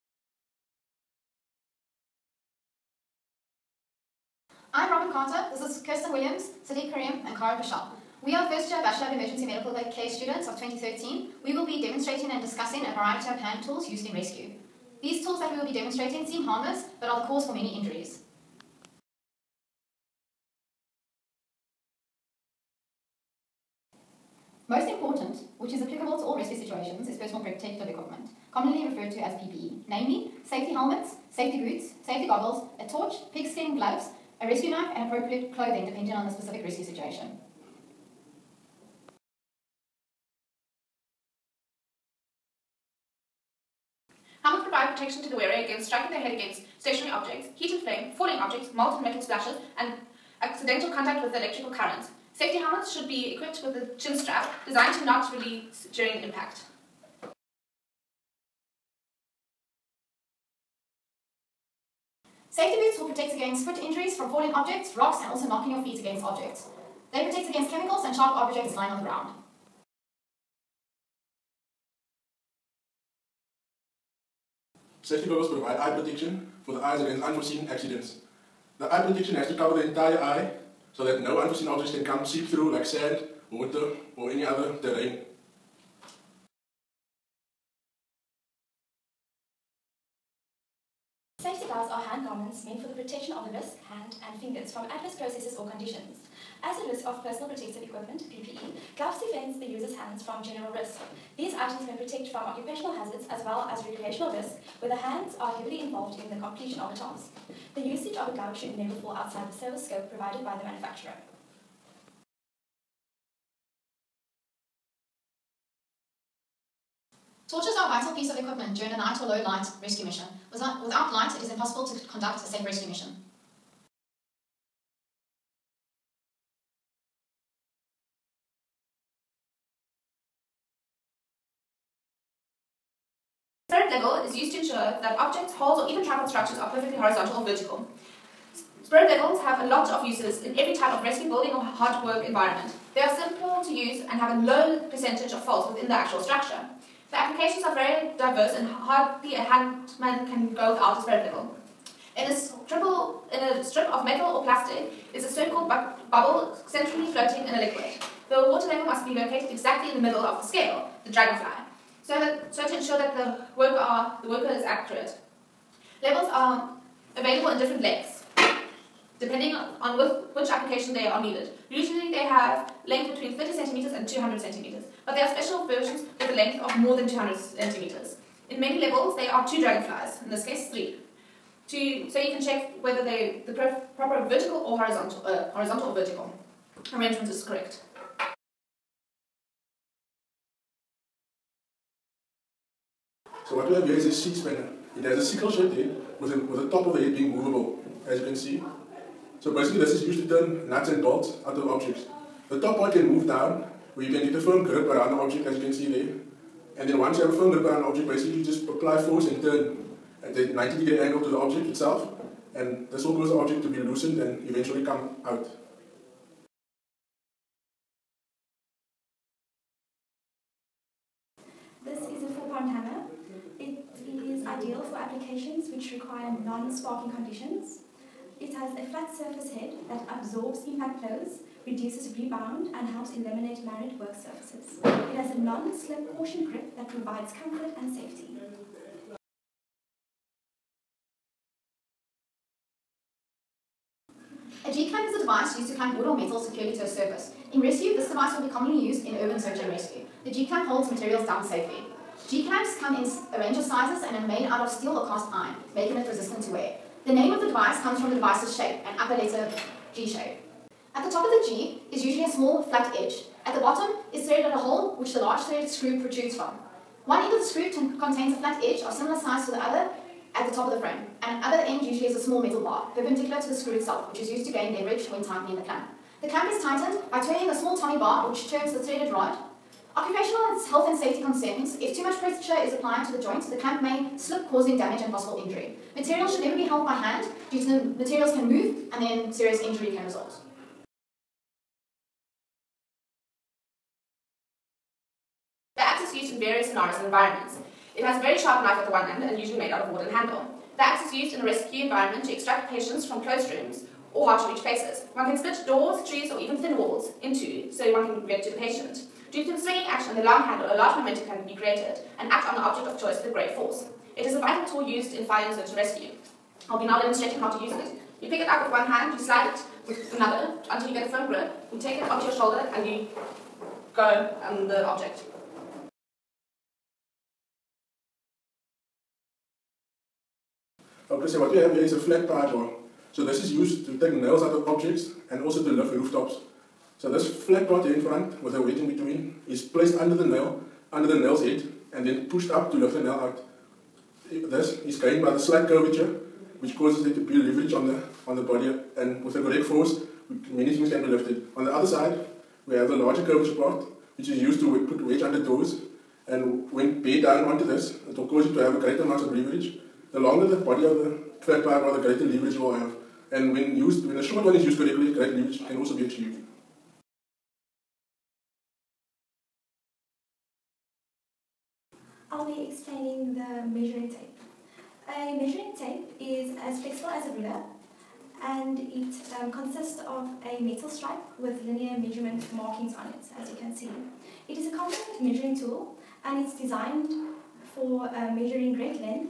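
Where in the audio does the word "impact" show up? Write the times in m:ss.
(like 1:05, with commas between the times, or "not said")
0:56, 3:50.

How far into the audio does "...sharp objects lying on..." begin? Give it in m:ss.
1:08.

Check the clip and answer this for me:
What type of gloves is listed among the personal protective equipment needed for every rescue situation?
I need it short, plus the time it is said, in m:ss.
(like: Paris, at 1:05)
Pigskin gloves, at 0:33.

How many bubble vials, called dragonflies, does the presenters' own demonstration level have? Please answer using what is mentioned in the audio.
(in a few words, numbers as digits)
3.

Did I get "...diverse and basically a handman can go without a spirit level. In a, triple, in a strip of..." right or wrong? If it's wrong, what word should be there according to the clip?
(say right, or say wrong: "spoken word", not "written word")
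wrong: "hardly", not "basically".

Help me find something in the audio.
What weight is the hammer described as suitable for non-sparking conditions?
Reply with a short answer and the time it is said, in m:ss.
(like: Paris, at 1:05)
4 pounds, at 3:42.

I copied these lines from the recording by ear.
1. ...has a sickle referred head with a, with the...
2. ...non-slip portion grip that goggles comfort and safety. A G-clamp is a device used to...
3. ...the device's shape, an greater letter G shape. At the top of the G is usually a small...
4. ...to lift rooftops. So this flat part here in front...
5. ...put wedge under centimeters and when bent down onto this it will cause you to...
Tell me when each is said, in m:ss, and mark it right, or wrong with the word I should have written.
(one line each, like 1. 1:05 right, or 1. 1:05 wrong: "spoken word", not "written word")
1. 3:15 wrong: "shaped", not "referred"
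2. 3:55 wrong: "provides", not "goggles"
3. 4:18 wrong: "upper", not "greater"
4. 5:35 right
5. 5:54 wrong: "doors", not "centimeters".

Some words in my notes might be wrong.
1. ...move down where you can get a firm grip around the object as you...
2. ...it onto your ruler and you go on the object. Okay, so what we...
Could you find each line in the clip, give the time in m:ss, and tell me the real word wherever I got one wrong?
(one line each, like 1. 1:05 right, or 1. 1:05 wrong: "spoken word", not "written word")
1. 3:23 right
2. 5:21 wrong: "shoulder", not "ruler".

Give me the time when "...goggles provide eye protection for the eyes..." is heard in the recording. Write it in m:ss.
1:15.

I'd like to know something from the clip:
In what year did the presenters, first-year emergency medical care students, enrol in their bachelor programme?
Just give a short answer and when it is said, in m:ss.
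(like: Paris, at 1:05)
2013, at 0:10.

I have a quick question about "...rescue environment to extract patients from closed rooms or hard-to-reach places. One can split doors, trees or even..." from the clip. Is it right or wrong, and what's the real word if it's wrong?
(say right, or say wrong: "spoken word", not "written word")
right.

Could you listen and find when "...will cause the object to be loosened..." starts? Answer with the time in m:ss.
3:33.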